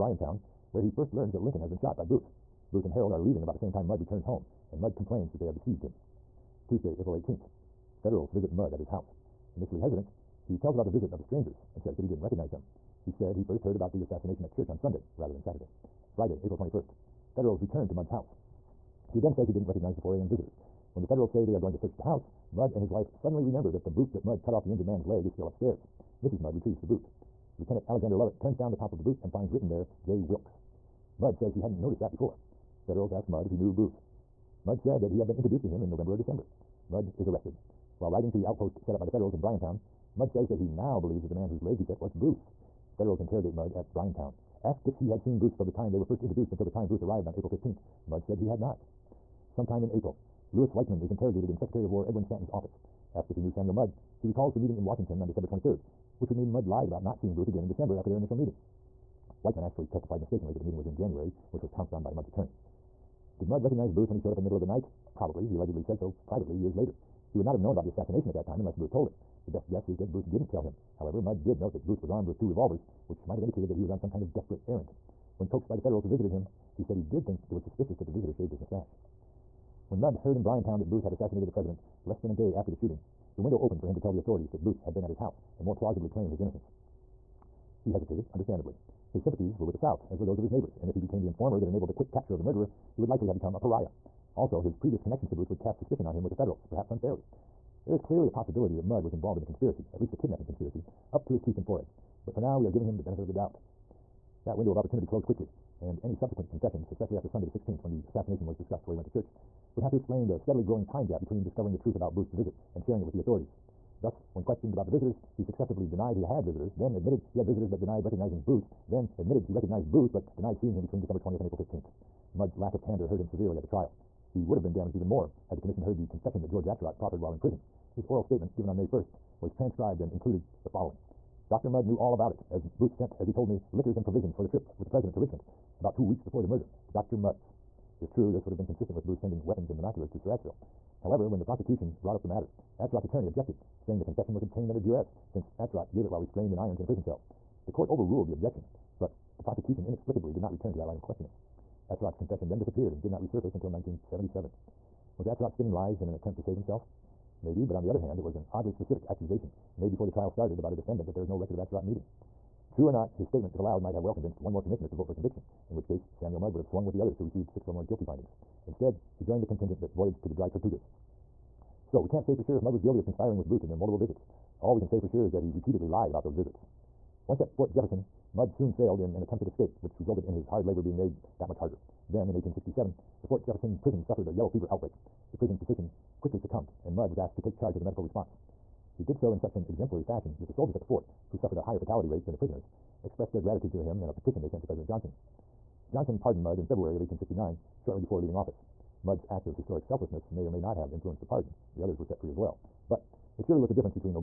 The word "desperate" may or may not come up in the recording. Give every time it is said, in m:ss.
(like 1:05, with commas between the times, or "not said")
1:14.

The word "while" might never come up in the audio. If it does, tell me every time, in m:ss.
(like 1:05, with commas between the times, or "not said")
0:38, 2:07, 2:26.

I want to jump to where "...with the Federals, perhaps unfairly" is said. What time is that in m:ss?
1:36.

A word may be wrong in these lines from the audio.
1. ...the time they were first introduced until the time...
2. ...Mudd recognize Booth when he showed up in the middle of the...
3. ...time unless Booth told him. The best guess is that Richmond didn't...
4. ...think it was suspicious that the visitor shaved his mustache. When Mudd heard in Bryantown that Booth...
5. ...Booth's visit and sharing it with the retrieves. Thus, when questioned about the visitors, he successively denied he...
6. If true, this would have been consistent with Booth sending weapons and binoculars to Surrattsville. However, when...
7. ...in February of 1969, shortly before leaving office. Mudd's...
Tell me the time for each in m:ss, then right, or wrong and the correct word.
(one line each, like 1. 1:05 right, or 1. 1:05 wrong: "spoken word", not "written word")
1. 0:45 right
2. 1:03 right
3. 1:08 wrong: "Booth", not "Richmond"
4. 1:17 right
5. 1:52 wrong: "authorities", not "retrieves"
6. 2:18 right
7. 3:16 wrong: "1869", not "1969".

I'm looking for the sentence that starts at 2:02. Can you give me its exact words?
Mudd's lack of candor hurt him severely at the trial.